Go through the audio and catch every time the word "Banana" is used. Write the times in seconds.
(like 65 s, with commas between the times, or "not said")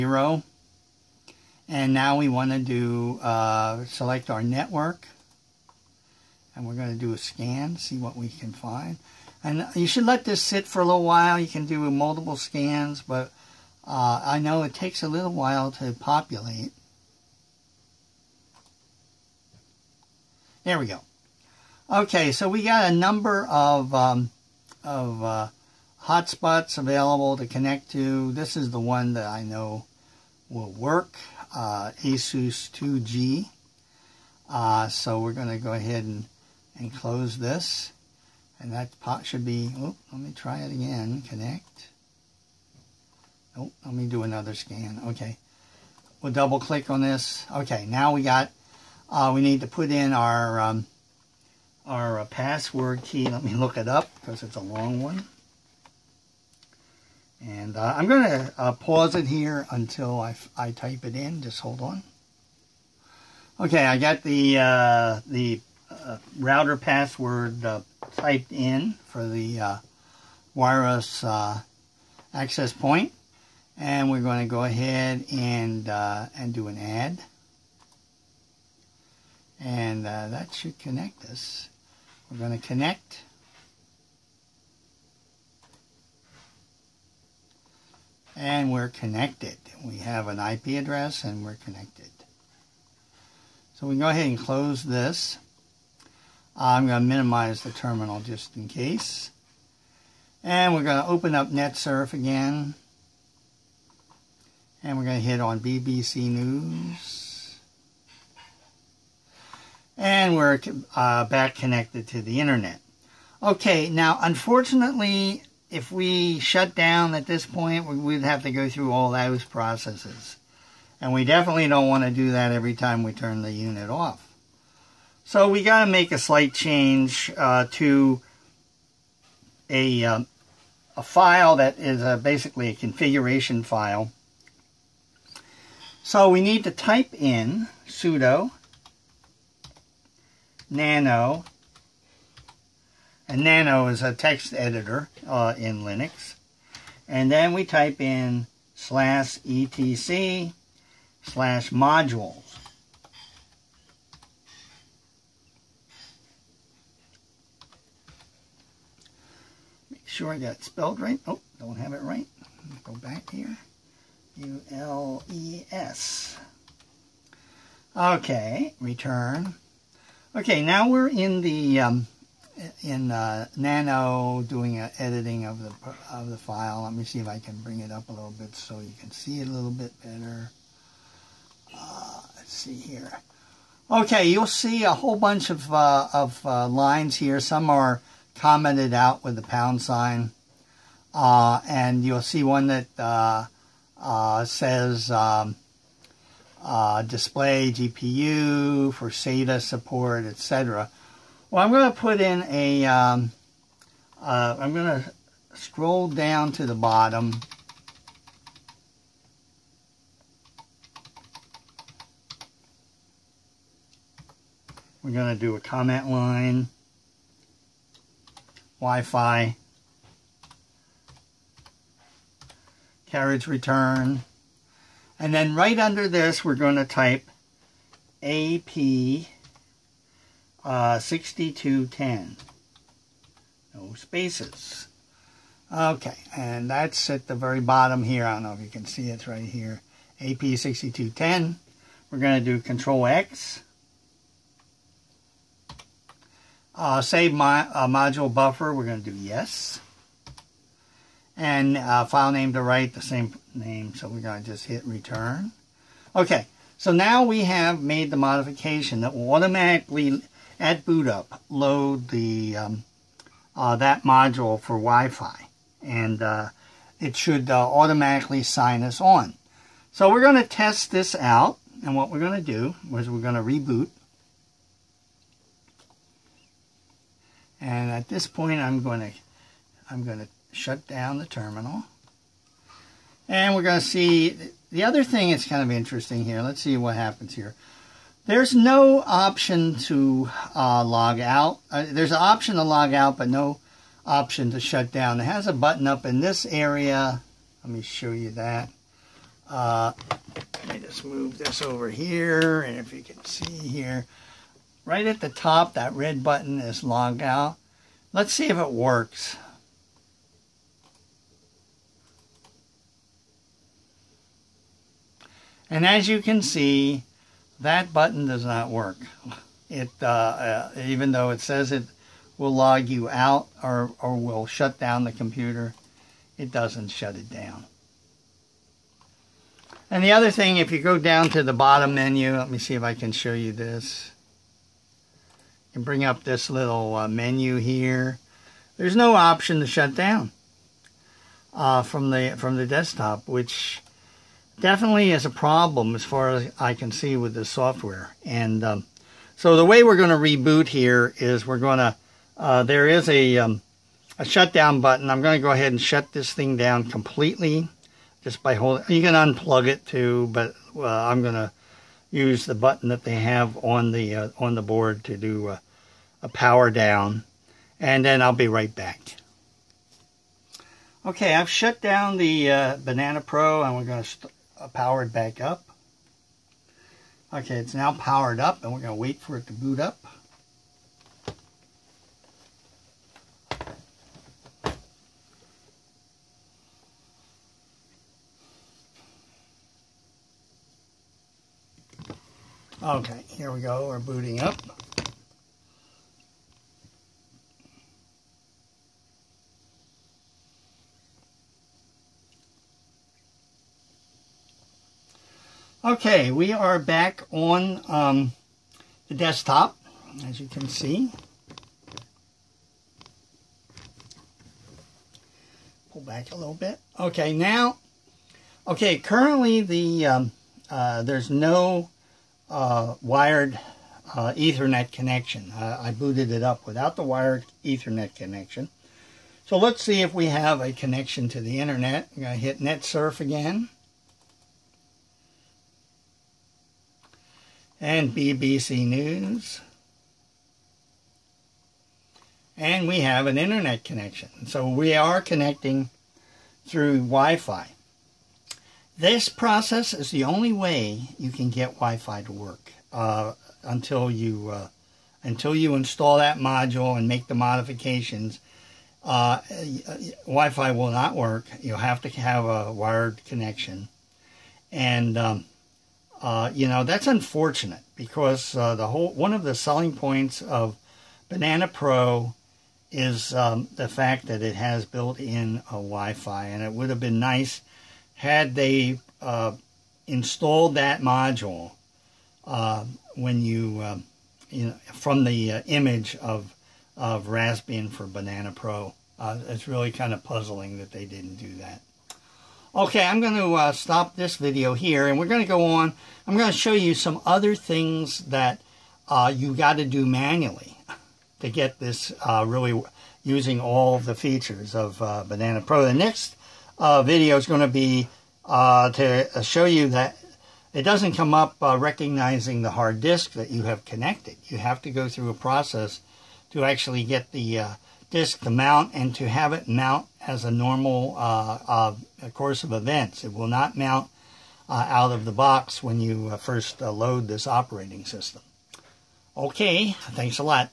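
372 s, 471 s, 488 s, 505 s.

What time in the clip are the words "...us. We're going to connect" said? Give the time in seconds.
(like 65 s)
81 s.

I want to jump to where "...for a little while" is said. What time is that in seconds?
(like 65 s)
10 s.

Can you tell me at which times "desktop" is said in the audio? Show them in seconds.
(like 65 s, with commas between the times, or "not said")
342 s, 409 s.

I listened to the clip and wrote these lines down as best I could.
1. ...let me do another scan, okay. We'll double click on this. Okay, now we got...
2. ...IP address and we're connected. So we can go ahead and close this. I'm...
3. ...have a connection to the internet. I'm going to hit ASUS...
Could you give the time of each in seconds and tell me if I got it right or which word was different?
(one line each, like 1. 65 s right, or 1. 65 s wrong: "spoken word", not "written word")
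1. 43 s right
2. 90 s right
3. 430 s wrong: "NetSurf", not "ASUS".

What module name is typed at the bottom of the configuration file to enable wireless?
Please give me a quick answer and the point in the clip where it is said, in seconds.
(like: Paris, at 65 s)
AP6210, at 240 s.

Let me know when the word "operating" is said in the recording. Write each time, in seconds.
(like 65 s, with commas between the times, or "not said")
527 s.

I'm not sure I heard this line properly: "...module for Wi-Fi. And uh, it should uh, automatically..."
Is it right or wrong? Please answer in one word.
right.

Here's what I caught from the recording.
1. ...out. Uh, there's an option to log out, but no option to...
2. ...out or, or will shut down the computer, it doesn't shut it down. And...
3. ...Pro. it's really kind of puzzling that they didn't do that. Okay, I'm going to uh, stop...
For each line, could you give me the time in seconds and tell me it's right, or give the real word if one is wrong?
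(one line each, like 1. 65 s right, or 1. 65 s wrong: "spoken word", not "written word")
1. 291 s right
2. 323 s right
3. 488 s right.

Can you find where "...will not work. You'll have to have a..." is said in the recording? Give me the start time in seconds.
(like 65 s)
460 s.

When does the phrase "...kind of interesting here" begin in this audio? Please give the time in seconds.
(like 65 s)
285 s.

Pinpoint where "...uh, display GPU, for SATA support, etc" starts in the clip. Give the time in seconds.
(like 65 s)
196 s.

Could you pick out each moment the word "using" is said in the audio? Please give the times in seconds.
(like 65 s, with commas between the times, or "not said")
503 s.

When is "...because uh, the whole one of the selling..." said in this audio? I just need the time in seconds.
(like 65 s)
467 s.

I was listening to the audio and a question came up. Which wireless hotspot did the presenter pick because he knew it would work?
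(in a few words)
ASUS 2G.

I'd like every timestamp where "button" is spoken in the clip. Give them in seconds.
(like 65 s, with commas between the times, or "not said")
295 s, 306 s, 317 s, 354 s, 362 s.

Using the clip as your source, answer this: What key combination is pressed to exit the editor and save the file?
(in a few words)
Control X.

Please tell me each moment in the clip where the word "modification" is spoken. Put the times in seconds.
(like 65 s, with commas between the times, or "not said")
258 s, 457 s.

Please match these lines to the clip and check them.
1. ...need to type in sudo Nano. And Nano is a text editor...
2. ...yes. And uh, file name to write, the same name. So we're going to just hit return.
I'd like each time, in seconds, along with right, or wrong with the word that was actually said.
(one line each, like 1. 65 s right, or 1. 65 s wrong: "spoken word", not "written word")
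1. 136 s right
2. 249 s right.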